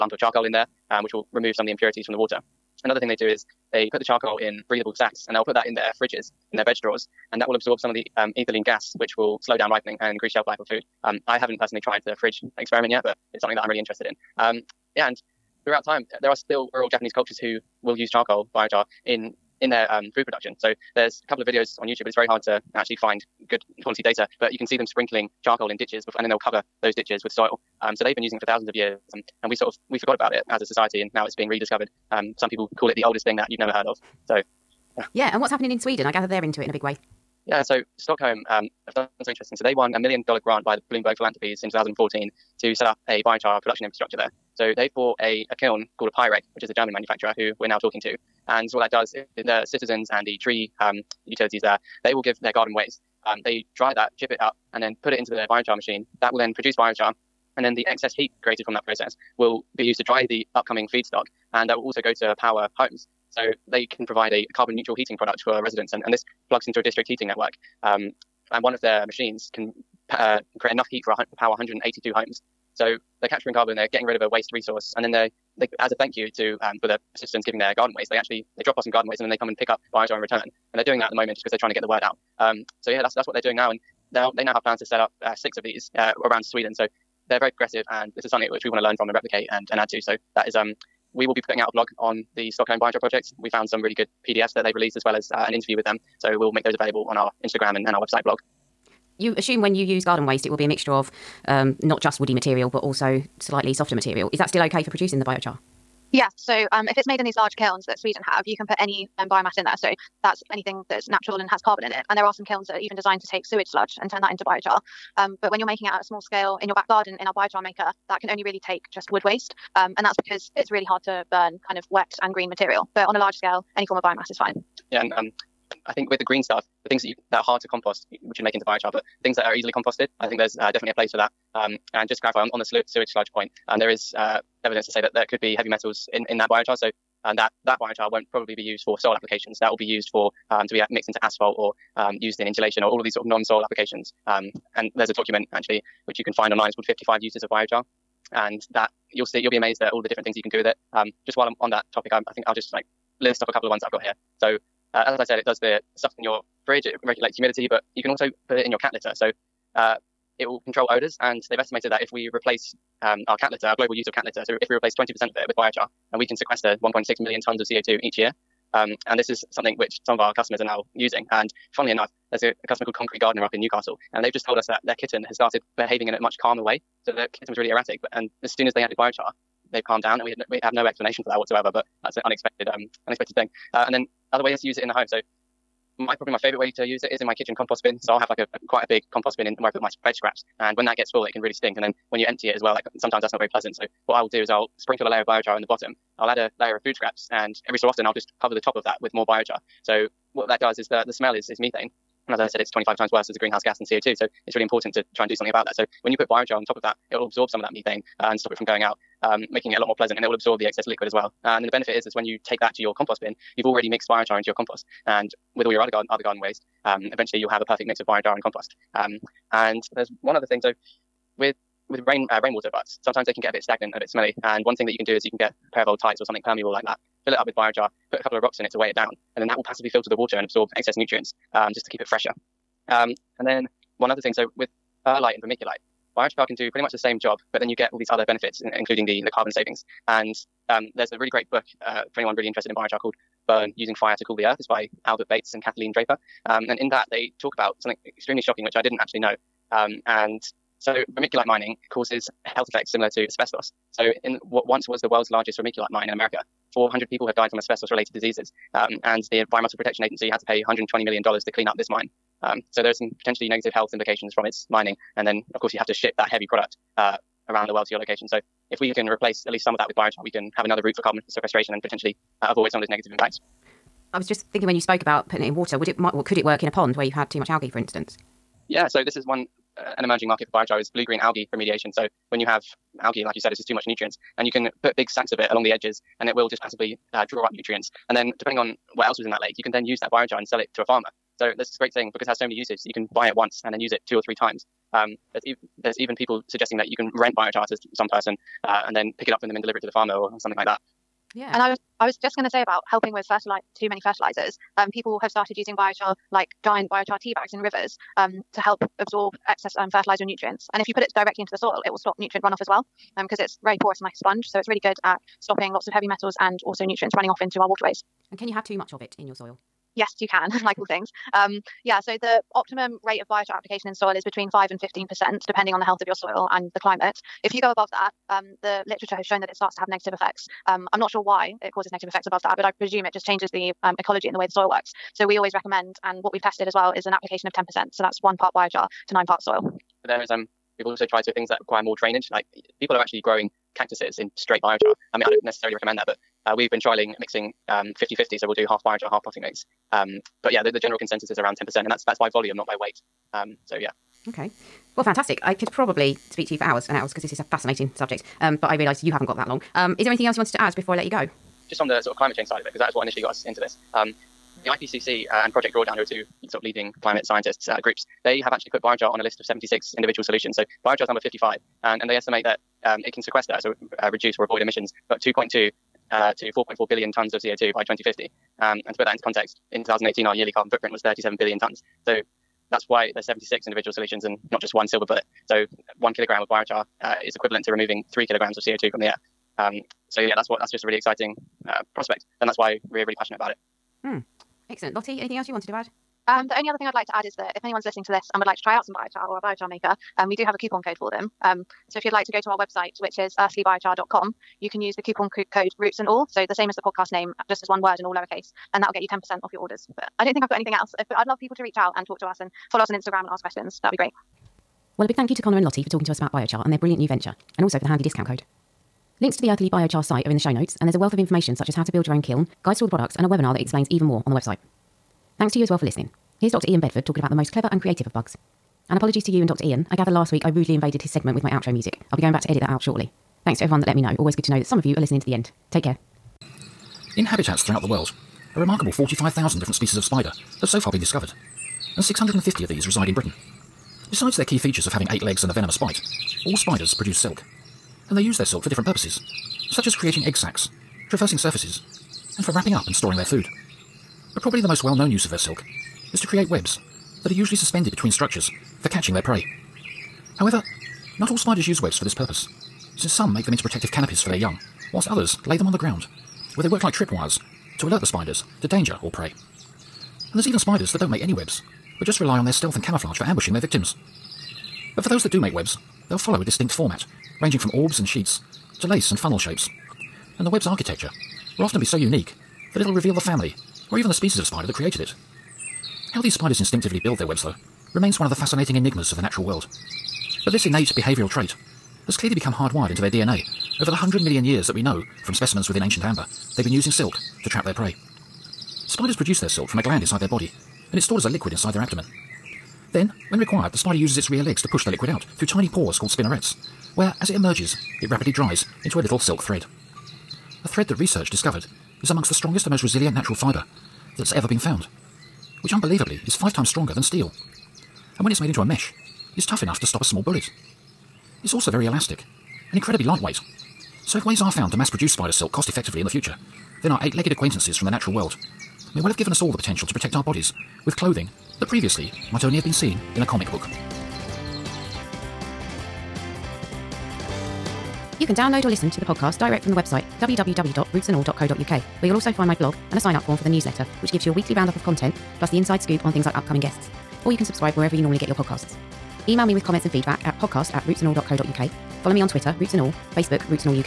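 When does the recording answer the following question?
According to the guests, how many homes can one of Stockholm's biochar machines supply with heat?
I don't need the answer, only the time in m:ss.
1:11.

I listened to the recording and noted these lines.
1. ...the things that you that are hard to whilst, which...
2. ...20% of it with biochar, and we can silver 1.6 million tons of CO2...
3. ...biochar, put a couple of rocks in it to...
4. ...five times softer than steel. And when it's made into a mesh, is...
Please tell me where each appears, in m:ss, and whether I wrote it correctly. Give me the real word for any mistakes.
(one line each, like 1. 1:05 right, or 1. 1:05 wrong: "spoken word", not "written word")
1. 2:06 wrong: "compost", not "whilst"
2. 2:44 wrong: "sequester", not "silver"
3. 3:47 right
4. 8:36 wrong: "stronger", not "softer".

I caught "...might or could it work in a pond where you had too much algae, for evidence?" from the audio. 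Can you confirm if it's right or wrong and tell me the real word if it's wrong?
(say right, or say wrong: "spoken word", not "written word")
wrong: "instance", not "evidence".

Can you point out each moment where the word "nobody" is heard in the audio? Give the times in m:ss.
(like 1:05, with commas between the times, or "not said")
not said.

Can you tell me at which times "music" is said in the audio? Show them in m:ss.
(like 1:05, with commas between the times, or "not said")
7:11.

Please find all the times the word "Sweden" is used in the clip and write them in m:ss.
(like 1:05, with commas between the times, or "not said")
0:35, 1:26, 1:47.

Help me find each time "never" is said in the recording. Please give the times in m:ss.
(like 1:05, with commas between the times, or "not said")
0:33.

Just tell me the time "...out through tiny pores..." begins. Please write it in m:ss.
8:25.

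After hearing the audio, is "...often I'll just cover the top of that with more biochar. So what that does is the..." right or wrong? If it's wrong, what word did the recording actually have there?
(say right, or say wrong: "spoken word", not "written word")
right.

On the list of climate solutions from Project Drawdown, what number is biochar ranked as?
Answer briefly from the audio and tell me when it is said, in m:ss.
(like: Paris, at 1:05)
55, at 6:11.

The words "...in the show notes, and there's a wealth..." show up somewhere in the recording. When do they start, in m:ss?
7:00.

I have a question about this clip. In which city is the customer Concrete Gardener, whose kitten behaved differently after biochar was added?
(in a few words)
Newcastle.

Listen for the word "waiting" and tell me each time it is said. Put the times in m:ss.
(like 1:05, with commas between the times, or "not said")
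not said.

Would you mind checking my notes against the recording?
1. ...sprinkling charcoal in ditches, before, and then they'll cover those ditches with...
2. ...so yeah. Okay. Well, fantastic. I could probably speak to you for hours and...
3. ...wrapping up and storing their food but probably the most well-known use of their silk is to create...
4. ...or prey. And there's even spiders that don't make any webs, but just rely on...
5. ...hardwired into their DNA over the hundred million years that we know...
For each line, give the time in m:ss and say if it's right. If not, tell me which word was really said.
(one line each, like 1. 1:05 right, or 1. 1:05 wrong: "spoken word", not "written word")
1. 0:24 right
2. 5:53 right
3. 7:32 right
4. 7:49 right
5. 8:12 right.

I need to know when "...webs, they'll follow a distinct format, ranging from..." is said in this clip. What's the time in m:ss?
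7:55.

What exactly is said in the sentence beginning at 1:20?
And they're doing that at the moment just because they're trying to get the word out.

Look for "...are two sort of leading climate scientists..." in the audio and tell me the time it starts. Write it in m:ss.
6:06.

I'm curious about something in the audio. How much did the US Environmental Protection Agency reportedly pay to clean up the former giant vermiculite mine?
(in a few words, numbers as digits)
$120 million.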